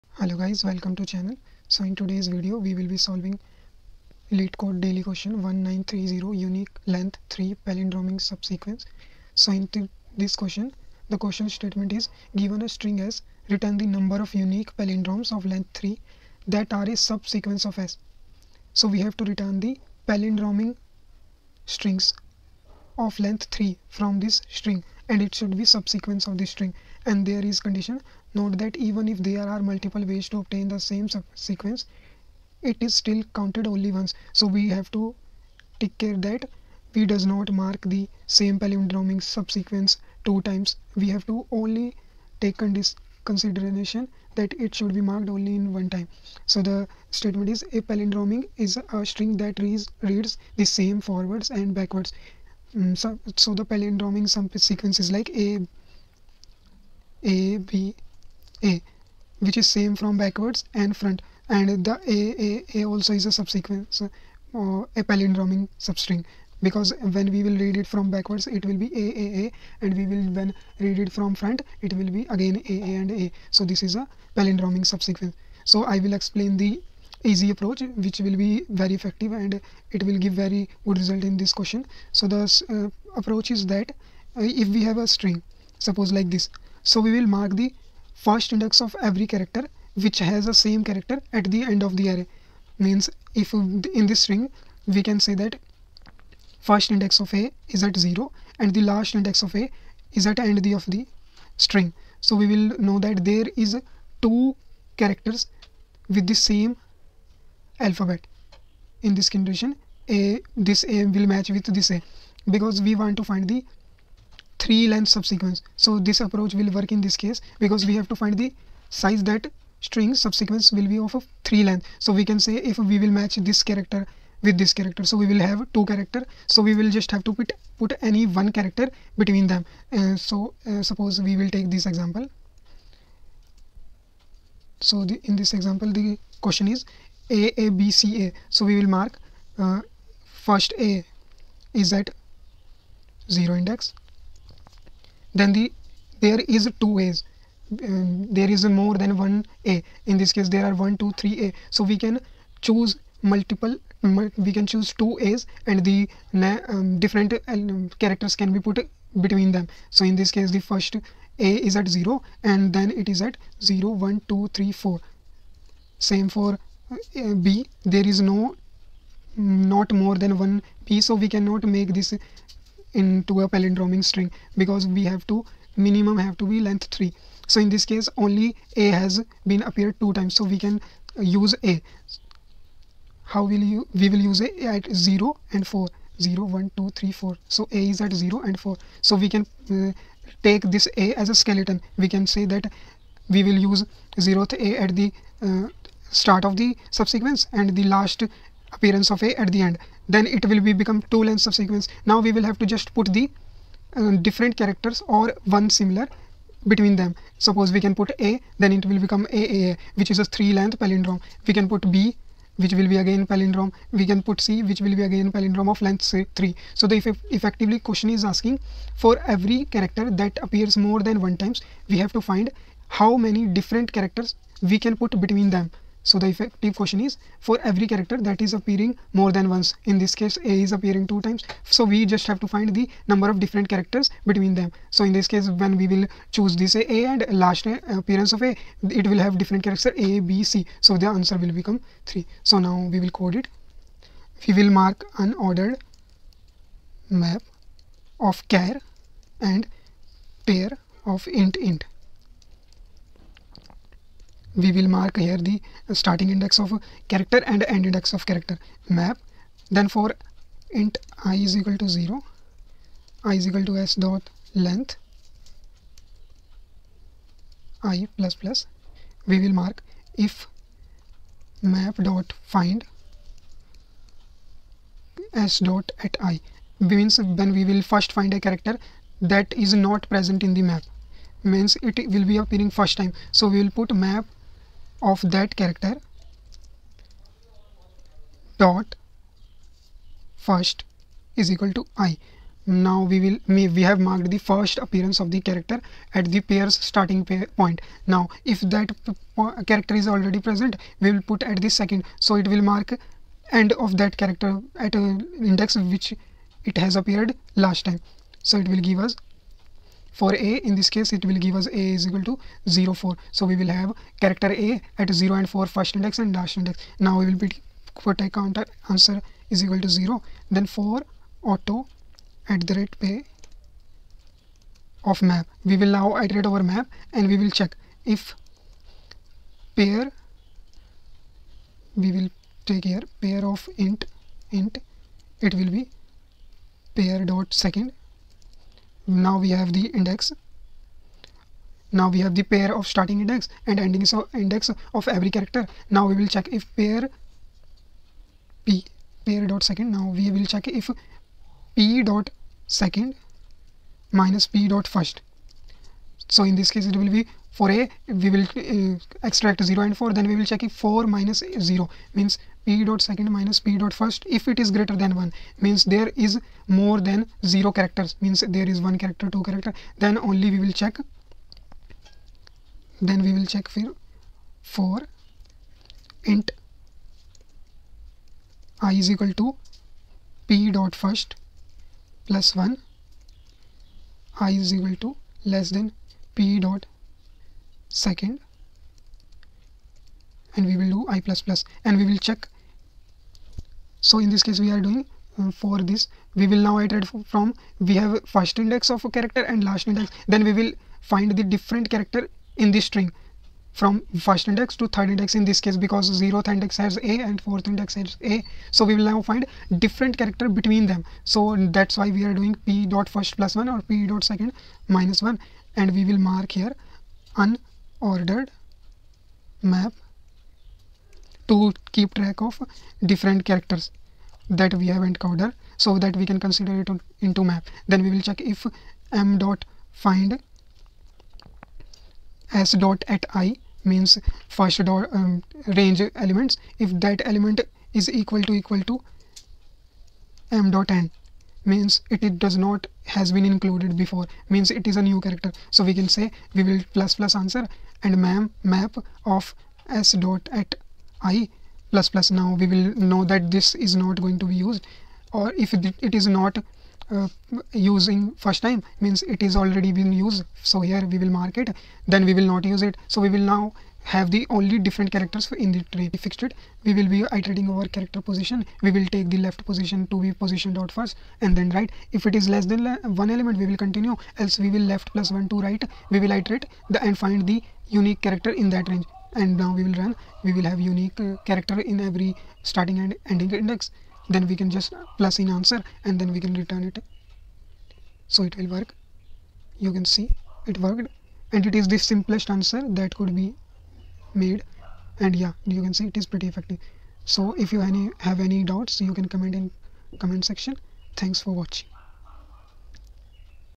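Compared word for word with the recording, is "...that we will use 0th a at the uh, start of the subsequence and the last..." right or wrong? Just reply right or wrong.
right.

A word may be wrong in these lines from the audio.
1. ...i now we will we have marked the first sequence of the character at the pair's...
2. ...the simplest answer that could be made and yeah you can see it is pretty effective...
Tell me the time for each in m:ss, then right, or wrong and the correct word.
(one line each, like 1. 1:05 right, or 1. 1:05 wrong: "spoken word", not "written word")
1. 4:51 wrong: "appearance", not "sequence"
2. 8:11 right.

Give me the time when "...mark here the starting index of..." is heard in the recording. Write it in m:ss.
4:14.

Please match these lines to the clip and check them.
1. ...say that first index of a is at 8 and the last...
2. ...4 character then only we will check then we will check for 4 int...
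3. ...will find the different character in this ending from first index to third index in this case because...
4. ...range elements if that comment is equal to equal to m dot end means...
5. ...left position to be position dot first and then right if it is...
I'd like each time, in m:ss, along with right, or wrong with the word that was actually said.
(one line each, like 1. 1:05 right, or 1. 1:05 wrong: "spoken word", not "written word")
1. 1:35 wrong: "0", not "8"
2. 6:09 wrong: "2", not "4"
3. 6:40 wrong: "string", not "ending"
4. 7:15 wrong: "element", not "comment"
5. 7:49 right.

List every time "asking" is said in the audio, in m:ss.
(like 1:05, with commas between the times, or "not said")
3:38.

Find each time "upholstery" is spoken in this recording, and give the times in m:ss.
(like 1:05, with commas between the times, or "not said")
not said.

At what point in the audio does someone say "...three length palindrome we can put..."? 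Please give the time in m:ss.
3:30.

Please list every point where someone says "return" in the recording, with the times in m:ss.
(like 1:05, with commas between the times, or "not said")
0:13, 0:19, 8:06.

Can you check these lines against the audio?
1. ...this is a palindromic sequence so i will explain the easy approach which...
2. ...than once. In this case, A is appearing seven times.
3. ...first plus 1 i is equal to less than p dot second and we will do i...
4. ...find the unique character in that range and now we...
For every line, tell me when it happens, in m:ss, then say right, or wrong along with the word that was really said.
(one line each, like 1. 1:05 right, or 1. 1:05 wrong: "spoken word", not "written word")
1. 1:13 wrong: "subsequence", not "sequence"
2. 3:49 wrong: "two", not "seven"
3. 6:21 right
4. 7:57 right.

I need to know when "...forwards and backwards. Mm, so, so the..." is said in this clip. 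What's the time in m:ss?
0:51.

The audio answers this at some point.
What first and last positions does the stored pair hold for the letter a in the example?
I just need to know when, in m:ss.
5:12.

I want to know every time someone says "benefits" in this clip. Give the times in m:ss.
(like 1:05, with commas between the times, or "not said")
not said.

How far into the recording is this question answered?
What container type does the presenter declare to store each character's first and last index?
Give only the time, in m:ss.
4:05.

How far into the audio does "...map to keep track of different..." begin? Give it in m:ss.
6:59.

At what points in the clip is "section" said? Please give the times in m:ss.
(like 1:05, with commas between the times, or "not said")
8:20.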